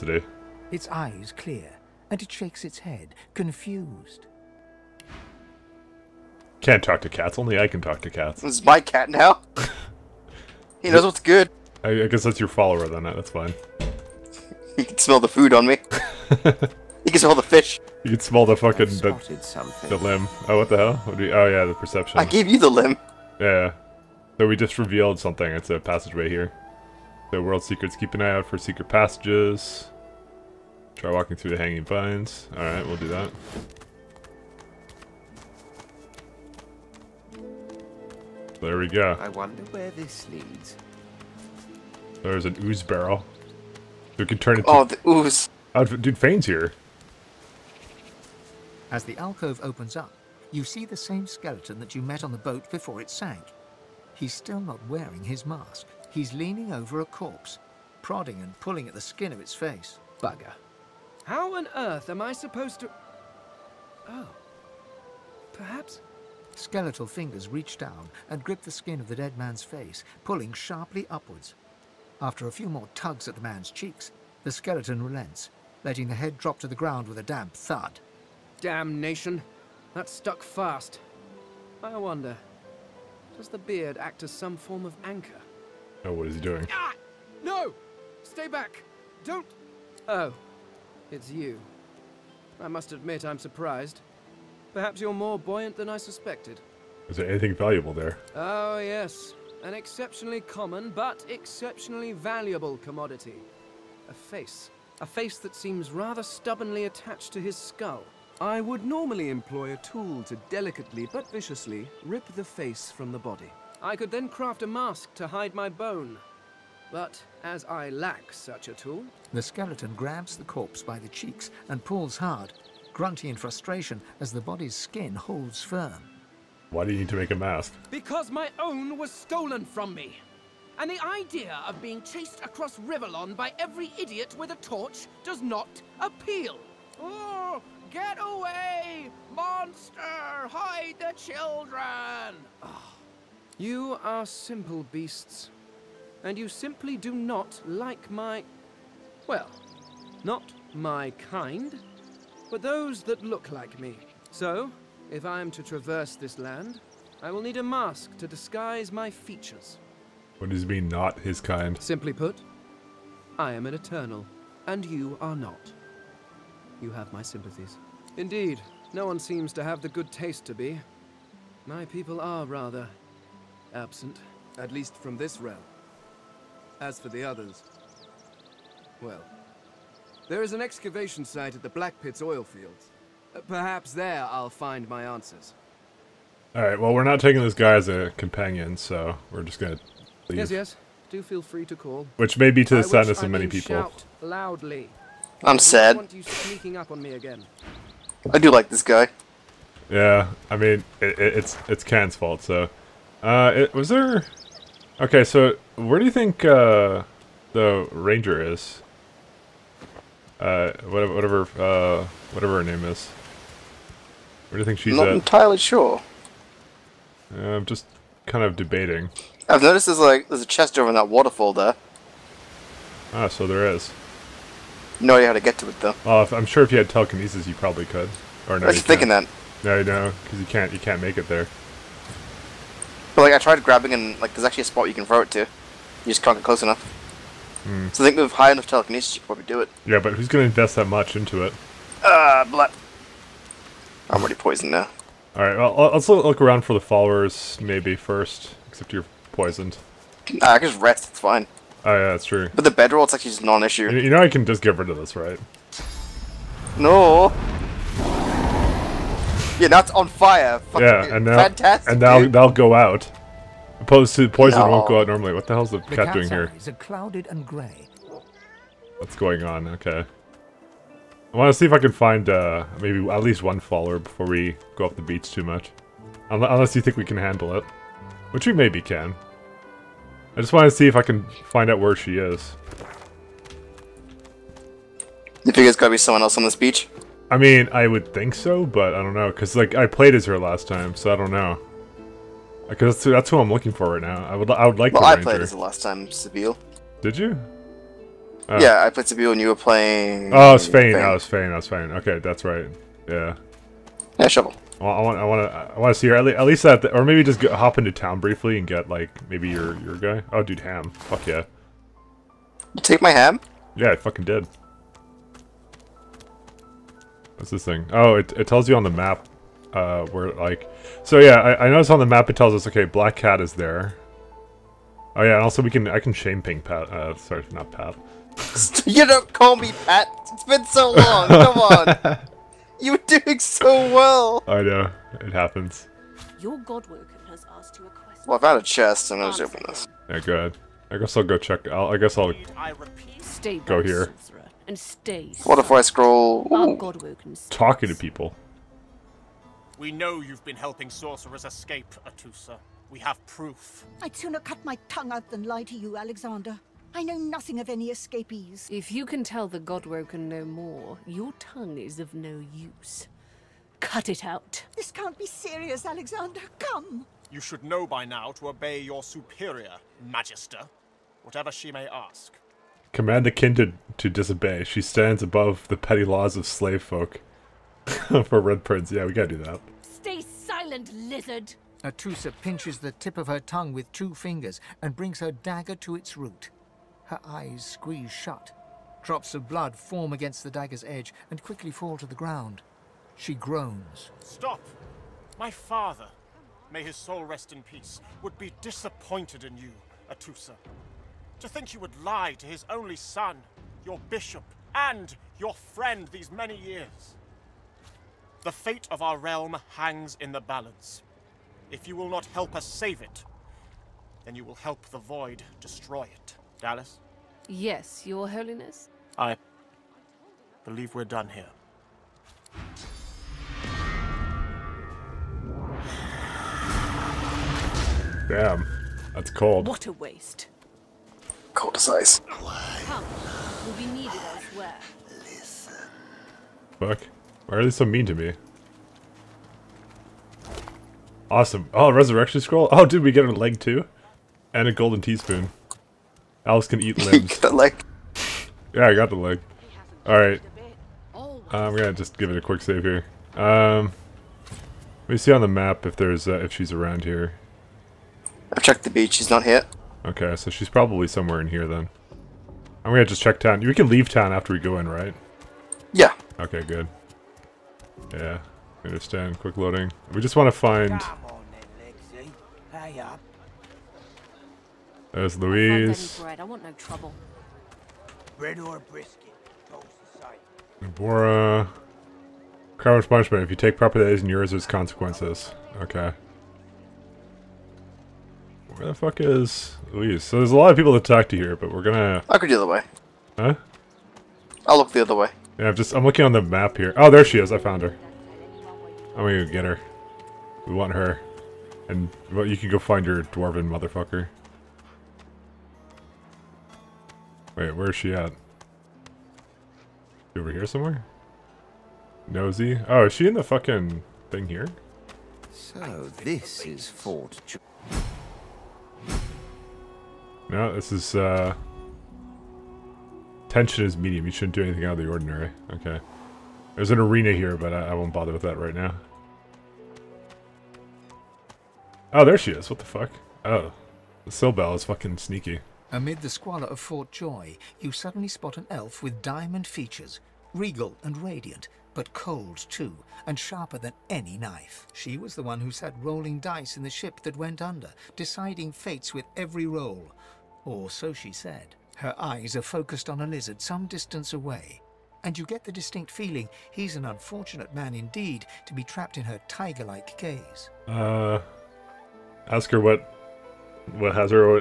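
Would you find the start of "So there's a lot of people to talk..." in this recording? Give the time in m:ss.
8:10.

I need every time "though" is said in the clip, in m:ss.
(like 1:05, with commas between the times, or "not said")
3:45.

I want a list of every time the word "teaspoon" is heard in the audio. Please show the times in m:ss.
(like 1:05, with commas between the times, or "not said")
7:25.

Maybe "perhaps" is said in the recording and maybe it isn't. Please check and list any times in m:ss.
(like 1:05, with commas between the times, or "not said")
1:05, 1:34, 3:03.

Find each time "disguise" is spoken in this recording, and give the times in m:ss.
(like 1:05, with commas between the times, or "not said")
2:38.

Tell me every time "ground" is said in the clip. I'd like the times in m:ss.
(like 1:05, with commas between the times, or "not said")
1:16, 6:32.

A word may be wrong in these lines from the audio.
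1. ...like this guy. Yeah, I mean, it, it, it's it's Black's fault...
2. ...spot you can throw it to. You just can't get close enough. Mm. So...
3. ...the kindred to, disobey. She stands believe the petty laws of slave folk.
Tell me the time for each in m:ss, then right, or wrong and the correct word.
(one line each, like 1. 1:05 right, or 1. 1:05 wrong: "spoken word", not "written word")
1. 3:18 wrong: "Can", not "Black"
2. 3:54 right
3. 6:13 wrong: "above", not "believe".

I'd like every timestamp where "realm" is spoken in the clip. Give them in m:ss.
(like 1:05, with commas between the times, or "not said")
2:55, 6:49.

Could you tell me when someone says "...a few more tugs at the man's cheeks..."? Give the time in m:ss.
1:12.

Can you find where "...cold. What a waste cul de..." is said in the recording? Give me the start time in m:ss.
7:09.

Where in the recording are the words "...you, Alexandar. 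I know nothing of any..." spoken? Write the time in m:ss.
5:55.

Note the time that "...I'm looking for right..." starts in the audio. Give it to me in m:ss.
4:53.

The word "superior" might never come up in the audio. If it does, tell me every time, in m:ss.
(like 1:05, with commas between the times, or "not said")
6:09.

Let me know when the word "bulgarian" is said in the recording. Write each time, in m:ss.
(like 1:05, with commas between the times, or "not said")
not said.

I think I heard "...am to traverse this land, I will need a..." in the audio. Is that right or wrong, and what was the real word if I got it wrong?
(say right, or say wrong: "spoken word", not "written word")
right.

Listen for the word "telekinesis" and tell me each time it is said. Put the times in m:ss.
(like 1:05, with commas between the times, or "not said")
3:46, 3:58.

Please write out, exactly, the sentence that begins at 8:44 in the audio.
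You shouldn't do anything out of the ordinary.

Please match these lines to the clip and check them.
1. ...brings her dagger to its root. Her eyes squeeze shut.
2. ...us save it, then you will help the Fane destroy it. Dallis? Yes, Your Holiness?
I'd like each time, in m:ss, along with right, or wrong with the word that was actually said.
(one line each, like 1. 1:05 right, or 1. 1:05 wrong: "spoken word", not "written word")
1. 6:24 right
2. 6:52 wrong: "Void", not "Fane".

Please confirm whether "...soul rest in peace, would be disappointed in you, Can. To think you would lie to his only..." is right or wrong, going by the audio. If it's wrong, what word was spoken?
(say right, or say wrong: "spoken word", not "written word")
wrong: "Atusa", not "Can".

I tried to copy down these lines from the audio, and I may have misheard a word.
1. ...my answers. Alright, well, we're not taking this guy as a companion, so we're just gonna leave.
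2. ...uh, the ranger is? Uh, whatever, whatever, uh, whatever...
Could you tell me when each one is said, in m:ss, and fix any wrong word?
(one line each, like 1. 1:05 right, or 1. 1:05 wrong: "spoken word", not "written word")
1. 3:04 right
2. 3:26 right.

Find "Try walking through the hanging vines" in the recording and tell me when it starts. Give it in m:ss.
0:30.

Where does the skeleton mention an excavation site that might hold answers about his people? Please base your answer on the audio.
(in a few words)
Black Pits oil fields.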